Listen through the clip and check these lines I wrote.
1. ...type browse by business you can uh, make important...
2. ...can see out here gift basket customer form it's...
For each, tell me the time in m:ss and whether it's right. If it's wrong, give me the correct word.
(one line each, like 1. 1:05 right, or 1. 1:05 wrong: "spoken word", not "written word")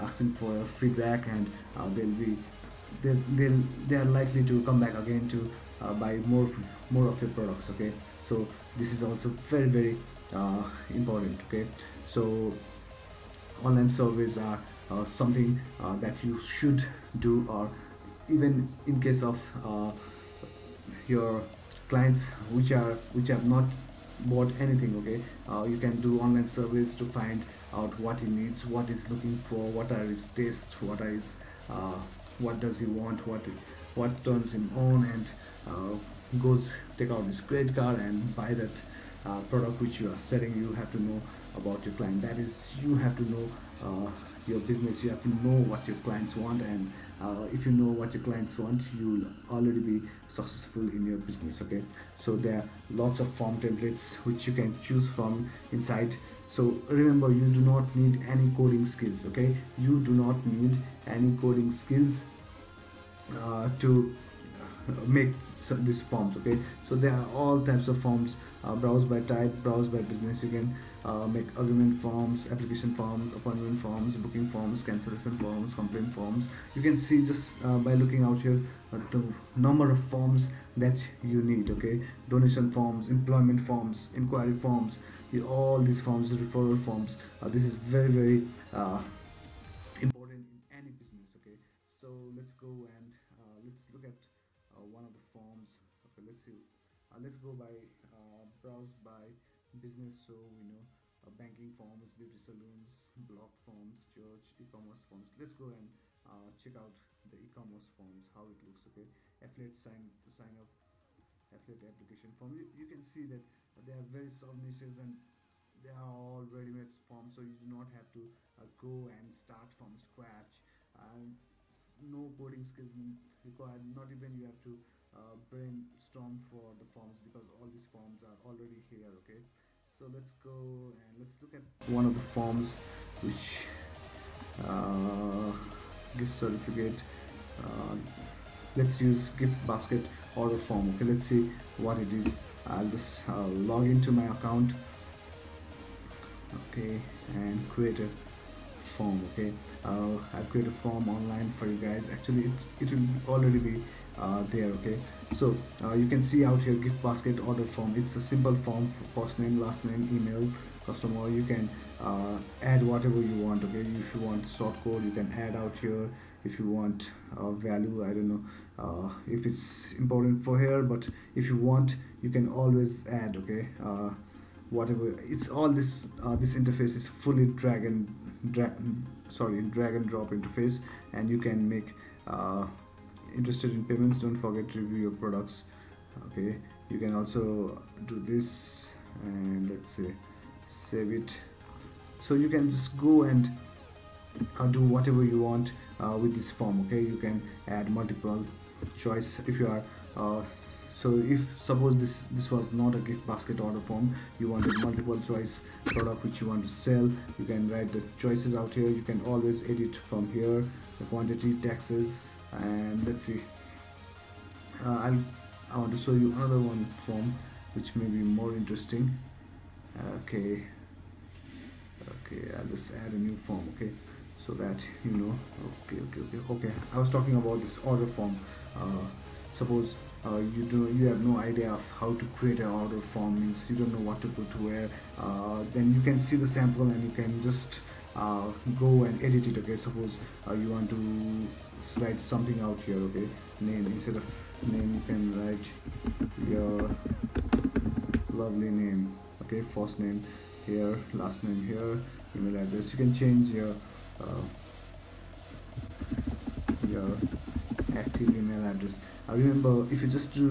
1. 1:09 wrong: "argument", not "important"
2. 2:36 wrong: "order", not "customer".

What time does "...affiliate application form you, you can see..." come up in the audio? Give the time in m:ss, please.
1:51.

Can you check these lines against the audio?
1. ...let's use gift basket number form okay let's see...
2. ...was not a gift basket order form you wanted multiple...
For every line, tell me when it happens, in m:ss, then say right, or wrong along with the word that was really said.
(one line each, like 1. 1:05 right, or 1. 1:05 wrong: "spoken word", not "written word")
1. 2:18 wrong: "order", not "number"
2. 3:22 right.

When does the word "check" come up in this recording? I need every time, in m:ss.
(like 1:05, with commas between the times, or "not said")
1:46.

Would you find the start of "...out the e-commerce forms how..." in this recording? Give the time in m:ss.
1:46.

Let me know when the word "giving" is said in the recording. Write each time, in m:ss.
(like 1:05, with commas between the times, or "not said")
not said.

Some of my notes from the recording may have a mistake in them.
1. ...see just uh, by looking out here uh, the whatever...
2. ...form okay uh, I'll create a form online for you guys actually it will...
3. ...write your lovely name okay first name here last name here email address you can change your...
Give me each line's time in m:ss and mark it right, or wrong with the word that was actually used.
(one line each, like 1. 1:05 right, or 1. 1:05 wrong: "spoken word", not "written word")
1. 1:16 wrong: "number", not "whatever"
2. 2:28 right
3. 4:05 right.